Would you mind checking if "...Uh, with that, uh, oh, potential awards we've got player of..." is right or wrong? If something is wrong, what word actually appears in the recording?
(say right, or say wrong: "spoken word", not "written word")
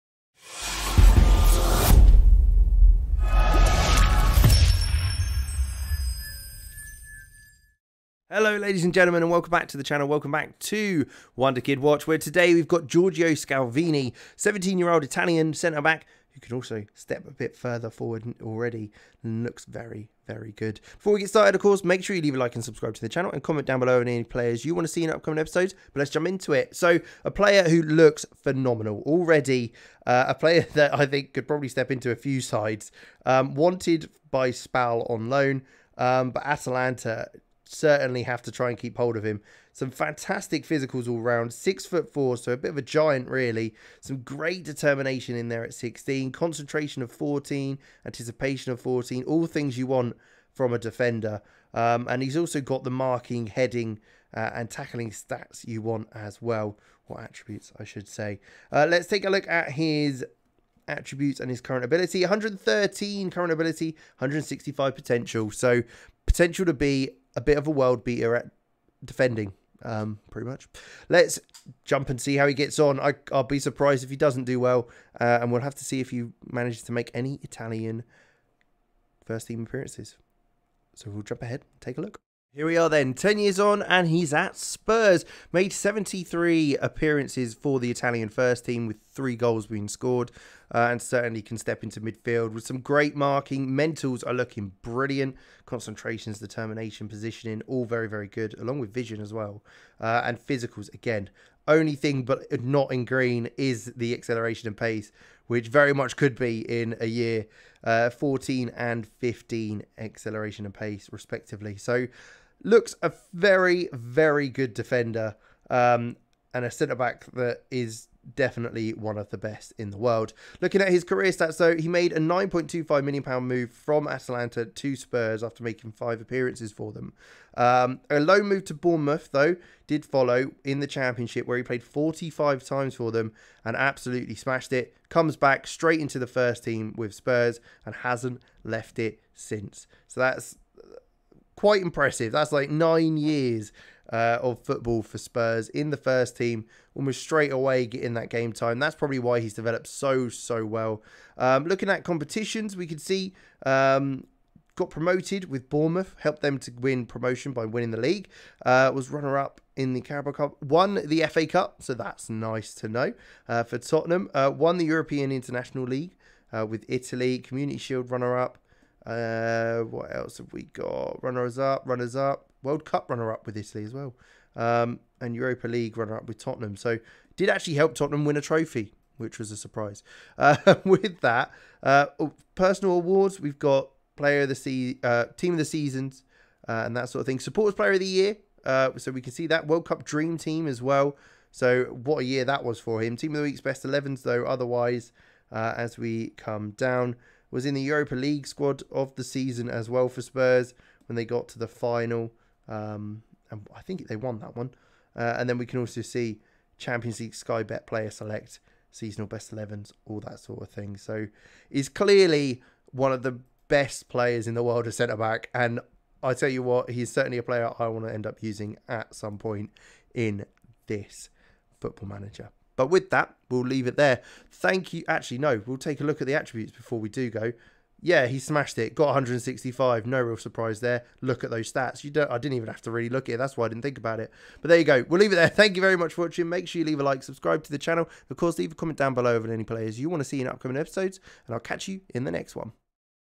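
wrong: "personal", not "potential".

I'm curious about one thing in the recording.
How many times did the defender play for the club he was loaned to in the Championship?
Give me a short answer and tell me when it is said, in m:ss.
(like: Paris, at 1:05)
45, at 2:11.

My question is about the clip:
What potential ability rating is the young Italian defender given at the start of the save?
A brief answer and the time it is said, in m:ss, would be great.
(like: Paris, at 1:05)
165, at 1:04.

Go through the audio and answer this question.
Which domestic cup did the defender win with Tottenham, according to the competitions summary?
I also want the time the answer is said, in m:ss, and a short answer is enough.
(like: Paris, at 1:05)
FA Cup, at 2:41.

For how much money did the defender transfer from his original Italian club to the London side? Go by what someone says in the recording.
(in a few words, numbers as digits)
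£9.25 million.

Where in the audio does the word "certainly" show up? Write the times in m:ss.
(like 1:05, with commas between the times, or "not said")
0:37, 1:31, 3:37.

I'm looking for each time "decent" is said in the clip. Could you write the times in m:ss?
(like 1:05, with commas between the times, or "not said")
not said.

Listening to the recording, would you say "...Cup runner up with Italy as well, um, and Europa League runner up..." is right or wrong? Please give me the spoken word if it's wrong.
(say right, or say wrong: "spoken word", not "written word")
right.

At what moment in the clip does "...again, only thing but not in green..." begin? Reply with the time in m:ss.
1:40.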